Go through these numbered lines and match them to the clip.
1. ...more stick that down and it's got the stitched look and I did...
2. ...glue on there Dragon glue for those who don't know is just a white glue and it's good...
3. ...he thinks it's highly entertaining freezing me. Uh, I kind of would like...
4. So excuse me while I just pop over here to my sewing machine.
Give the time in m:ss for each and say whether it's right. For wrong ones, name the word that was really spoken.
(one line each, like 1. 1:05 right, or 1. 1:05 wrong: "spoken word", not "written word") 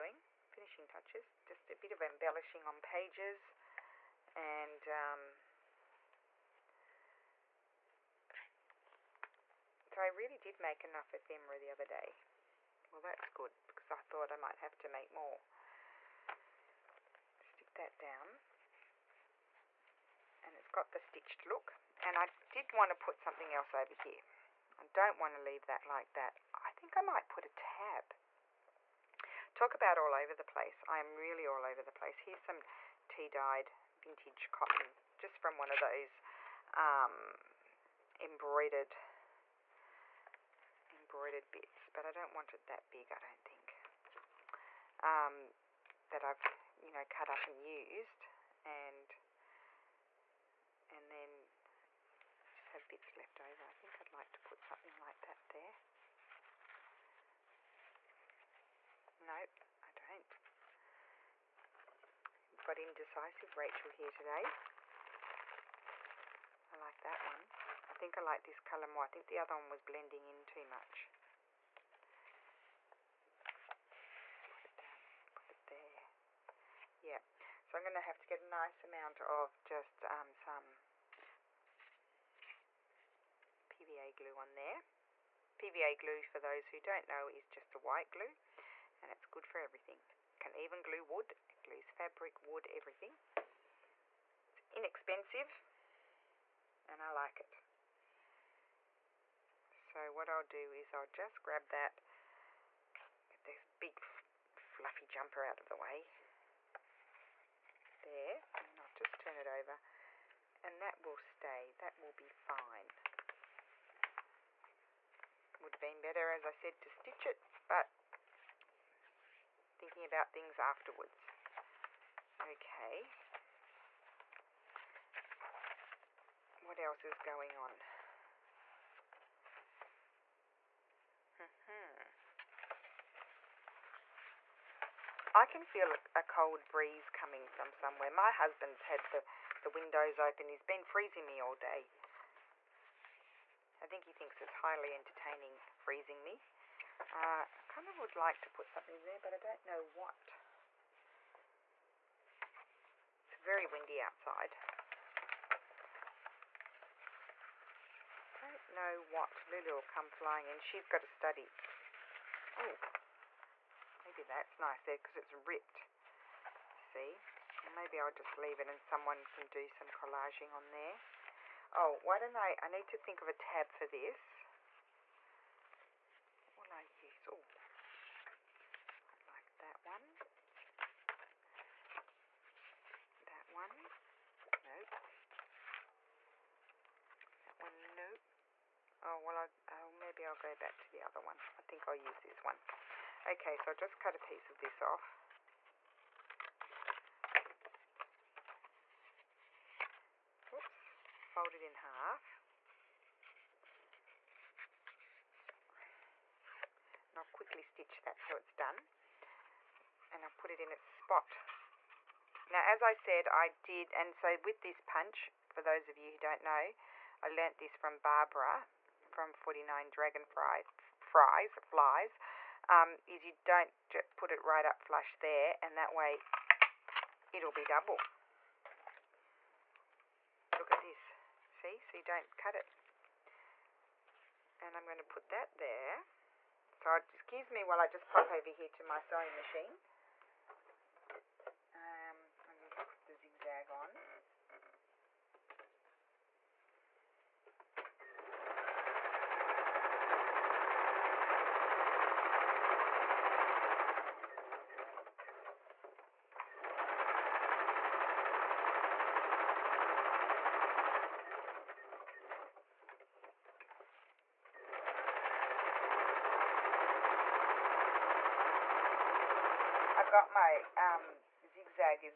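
1. 0:15 right
2. 1:24 wrong: "PVA", not "Dragon"
3. 2:24 right
4. 3:56 right.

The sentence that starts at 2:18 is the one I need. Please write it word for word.
My husband's had the, the windows open.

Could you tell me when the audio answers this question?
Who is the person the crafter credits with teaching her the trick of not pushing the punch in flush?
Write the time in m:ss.
3:37.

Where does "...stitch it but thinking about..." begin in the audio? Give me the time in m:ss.
1:56.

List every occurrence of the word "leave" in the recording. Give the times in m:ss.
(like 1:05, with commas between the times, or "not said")
0:25, 2:48.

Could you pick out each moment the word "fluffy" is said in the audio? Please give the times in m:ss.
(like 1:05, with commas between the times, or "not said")
1:44.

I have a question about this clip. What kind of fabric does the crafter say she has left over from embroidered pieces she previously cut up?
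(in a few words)
tea dyed vintage cotton.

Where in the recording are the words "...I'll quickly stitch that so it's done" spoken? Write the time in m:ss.
3:27.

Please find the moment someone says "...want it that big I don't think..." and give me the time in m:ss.
0:42.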